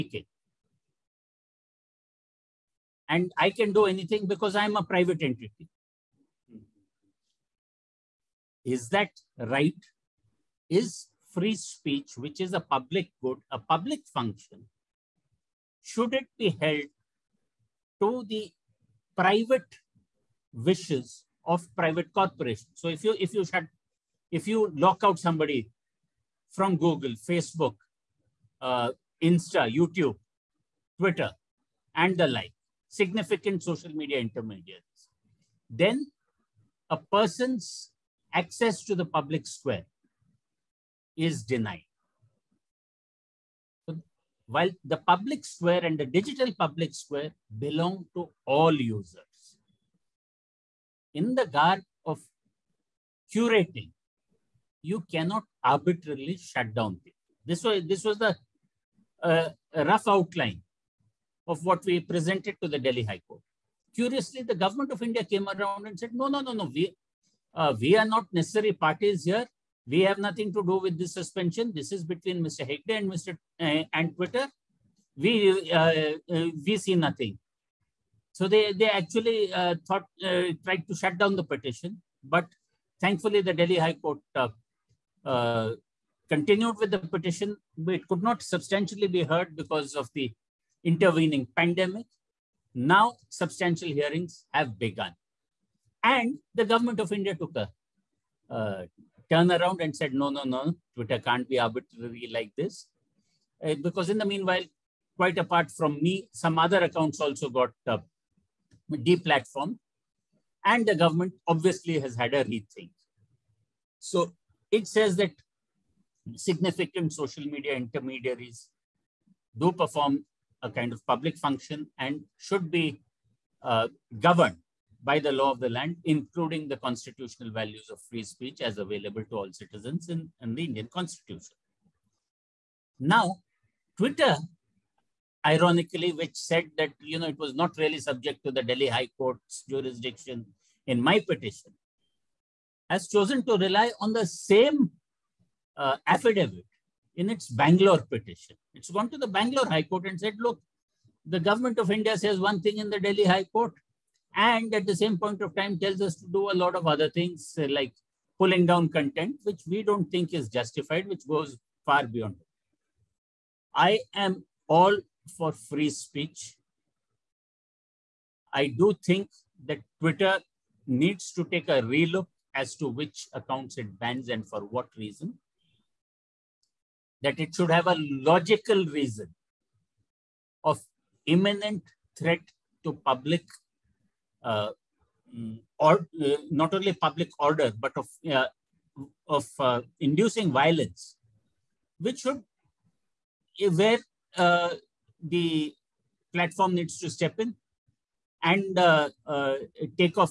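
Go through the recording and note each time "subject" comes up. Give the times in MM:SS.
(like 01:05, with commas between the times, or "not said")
02:17.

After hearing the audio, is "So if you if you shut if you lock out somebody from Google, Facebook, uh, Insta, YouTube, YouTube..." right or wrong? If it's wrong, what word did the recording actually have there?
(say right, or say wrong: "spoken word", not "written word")
wrong: "Twitter", not "YouTube".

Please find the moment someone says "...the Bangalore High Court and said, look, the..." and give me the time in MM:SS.
02:29.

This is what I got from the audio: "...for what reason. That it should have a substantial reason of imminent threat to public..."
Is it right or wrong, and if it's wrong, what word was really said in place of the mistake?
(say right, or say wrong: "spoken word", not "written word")
wrong: "logical", not "substantial".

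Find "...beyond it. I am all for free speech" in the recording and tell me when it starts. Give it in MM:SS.
02:42.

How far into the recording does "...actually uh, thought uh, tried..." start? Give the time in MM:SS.
01:18.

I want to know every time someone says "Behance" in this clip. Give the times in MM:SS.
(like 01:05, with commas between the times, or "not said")
not said.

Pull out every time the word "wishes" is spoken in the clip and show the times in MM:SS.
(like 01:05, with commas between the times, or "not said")
00:20.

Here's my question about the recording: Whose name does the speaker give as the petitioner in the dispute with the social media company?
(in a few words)
Mr. Hegde.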